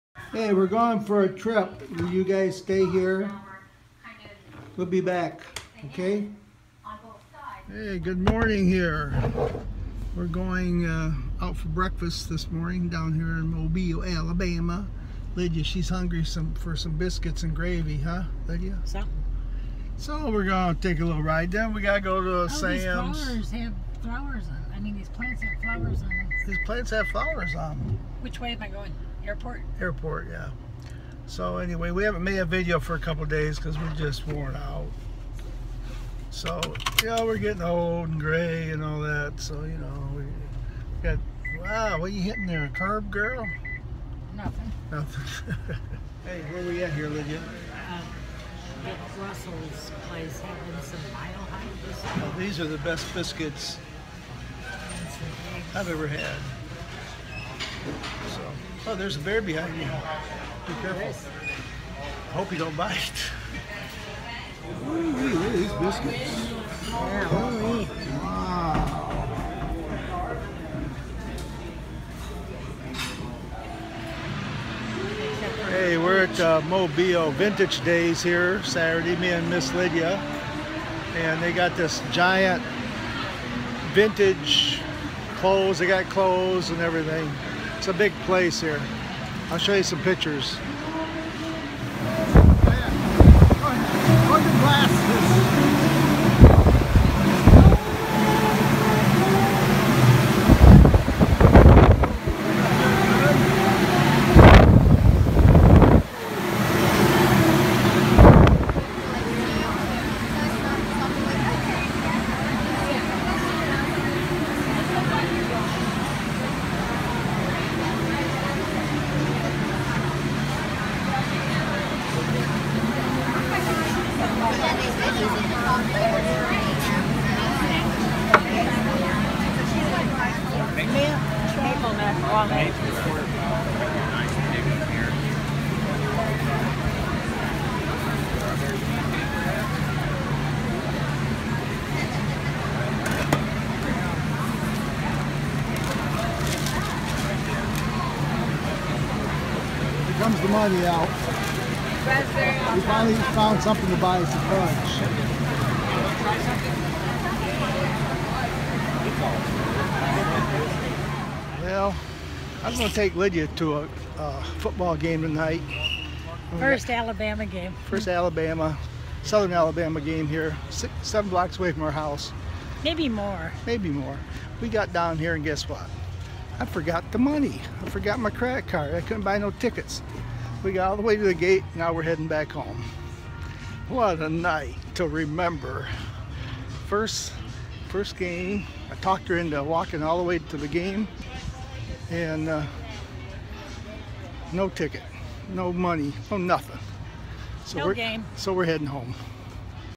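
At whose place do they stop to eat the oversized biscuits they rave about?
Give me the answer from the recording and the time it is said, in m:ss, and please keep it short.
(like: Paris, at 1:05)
Russell's, at 0:49.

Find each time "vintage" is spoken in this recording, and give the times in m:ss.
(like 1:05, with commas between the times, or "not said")
1:17, 1:23.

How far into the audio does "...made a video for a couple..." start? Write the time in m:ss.
0:32.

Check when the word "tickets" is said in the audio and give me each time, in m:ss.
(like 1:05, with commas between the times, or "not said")
2:59, 3:14.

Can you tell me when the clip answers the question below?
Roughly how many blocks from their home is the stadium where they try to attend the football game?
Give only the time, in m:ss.
2:50.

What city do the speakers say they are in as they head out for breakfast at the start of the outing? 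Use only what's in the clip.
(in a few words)
Mobile, Alabama.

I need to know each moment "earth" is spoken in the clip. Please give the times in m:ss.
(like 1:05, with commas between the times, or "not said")
not said.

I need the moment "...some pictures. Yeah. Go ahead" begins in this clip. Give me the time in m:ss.
1:29.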